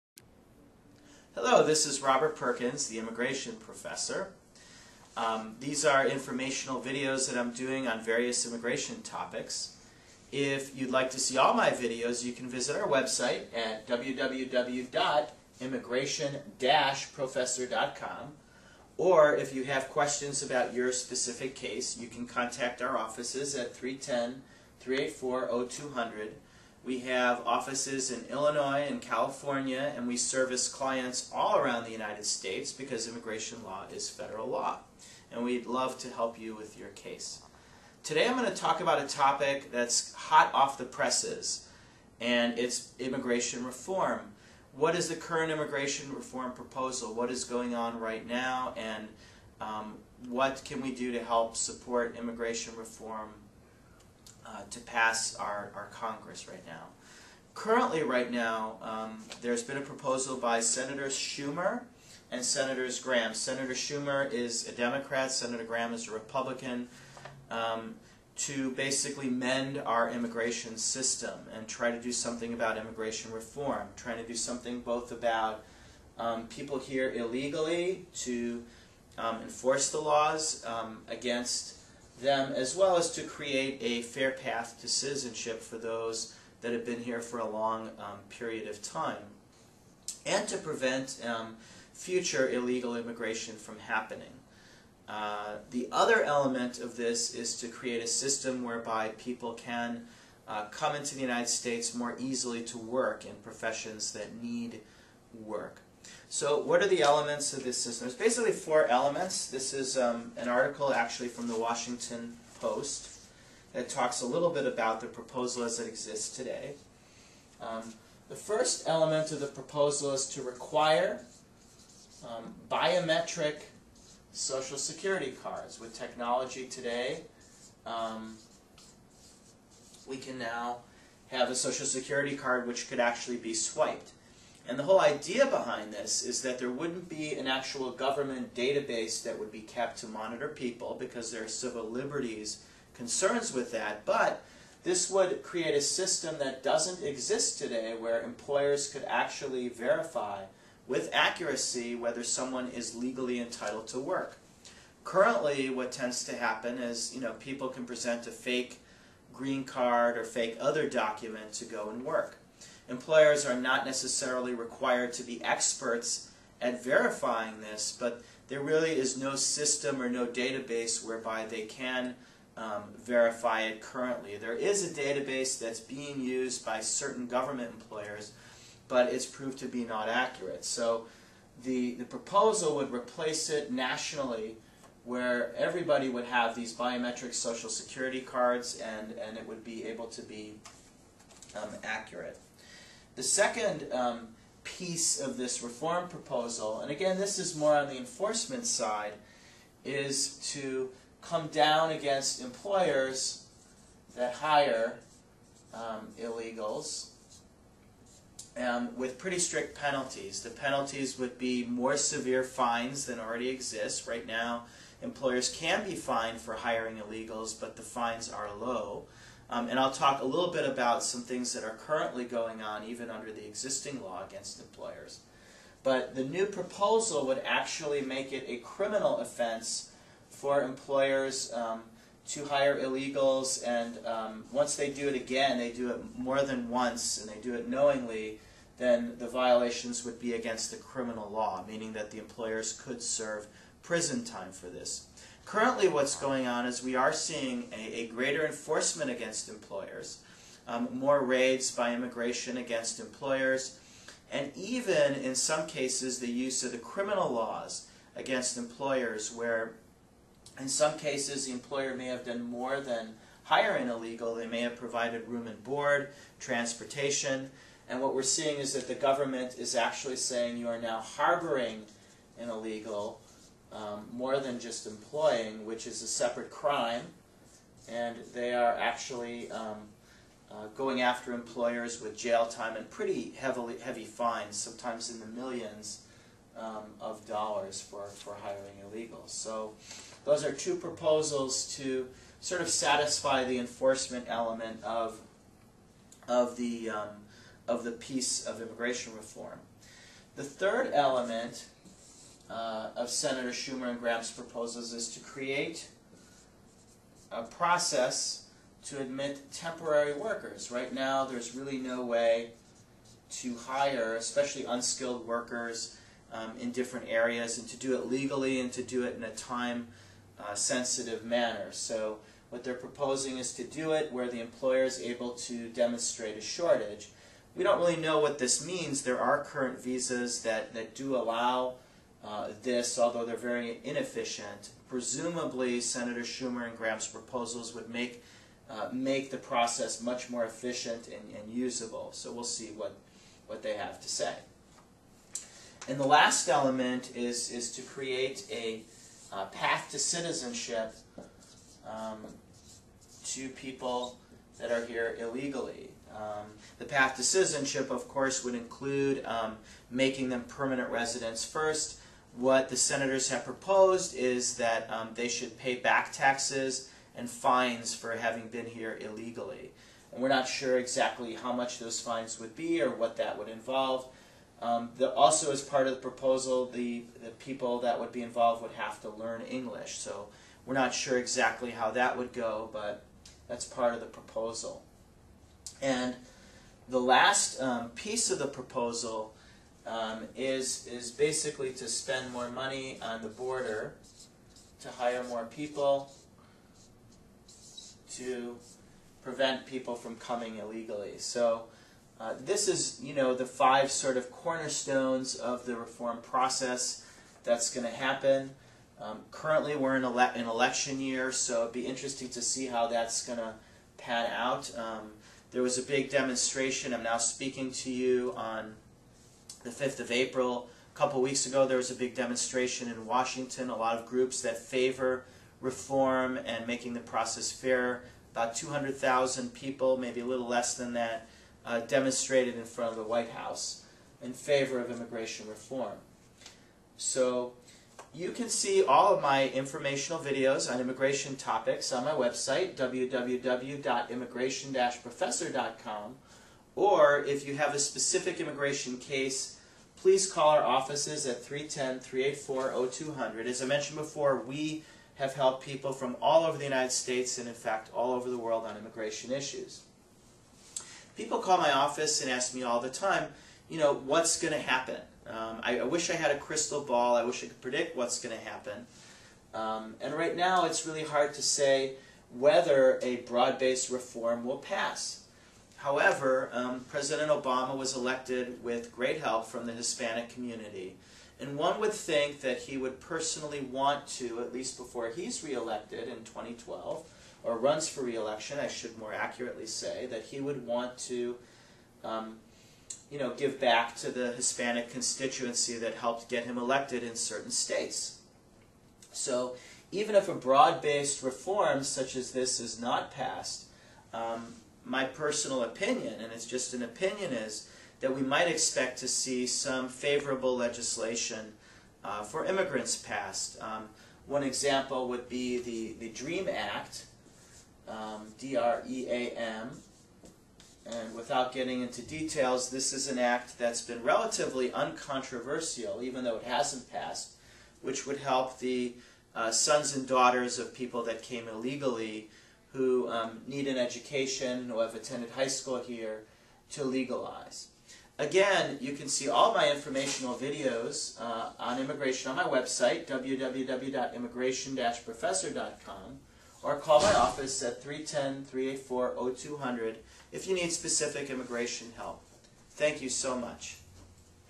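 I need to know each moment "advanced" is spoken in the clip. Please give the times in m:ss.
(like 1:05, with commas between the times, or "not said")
not said.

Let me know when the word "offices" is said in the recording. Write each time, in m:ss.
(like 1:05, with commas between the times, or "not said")
0:22, 0:27, 7:30, 7:41, 9:07.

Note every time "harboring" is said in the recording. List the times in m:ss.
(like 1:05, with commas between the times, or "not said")
4:31.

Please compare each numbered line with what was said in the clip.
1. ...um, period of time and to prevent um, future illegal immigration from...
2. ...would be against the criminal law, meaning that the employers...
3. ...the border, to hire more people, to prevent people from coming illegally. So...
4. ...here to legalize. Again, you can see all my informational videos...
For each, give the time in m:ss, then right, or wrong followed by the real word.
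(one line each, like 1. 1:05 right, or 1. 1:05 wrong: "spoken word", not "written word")
1. 1:27 right
2. 4:00 right
3. 6:33 right
4. 8:55 right.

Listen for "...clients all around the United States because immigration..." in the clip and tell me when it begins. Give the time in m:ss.
0:30.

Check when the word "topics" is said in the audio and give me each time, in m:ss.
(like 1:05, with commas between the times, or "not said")
0:09, 0:39, 7:21.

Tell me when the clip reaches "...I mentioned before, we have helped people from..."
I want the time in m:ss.
7:33.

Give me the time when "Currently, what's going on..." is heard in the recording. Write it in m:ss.
4:05.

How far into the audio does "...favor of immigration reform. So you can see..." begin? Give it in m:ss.
7:14.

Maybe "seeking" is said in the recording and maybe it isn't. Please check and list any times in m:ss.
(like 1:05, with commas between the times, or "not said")
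not said.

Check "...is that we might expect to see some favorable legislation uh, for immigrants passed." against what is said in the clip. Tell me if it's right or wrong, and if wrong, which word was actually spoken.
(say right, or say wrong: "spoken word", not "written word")
right.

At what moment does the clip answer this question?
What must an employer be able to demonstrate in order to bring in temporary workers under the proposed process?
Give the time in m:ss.
5:26.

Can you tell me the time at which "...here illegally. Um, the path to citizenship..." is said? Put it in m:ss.
5:54.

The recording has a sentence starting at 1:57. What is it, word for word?
Um, the first element of the proposal is to require um, biometric social security cards.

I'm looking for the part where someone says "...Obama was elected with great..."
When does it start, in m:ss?
7:57.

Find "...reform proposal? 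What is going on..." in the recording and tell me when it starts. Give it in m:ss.
0:46.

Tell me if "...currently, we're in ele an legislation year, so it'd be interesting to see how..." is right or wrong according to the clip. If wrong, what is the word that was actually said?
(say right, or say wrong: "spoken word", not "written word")
wrong: "election", not "legislation".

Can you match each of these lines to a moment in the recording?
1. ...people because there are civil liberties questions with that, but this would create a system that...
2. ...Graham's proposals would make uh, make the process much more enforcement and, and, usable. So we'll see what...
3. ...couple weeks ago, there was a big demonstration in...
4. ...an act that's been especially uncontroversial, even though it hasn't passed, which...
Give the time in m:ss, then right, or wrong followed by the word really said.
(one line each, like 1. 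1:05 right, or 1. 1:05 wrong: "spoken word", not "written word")
1. 2:20 wrong: "concerns", not "questions"
2. 5:36 wrong: "efficient", not "enforcement"
3. 7:00 right
4. 8:43 wrong: "relatively", not "especially".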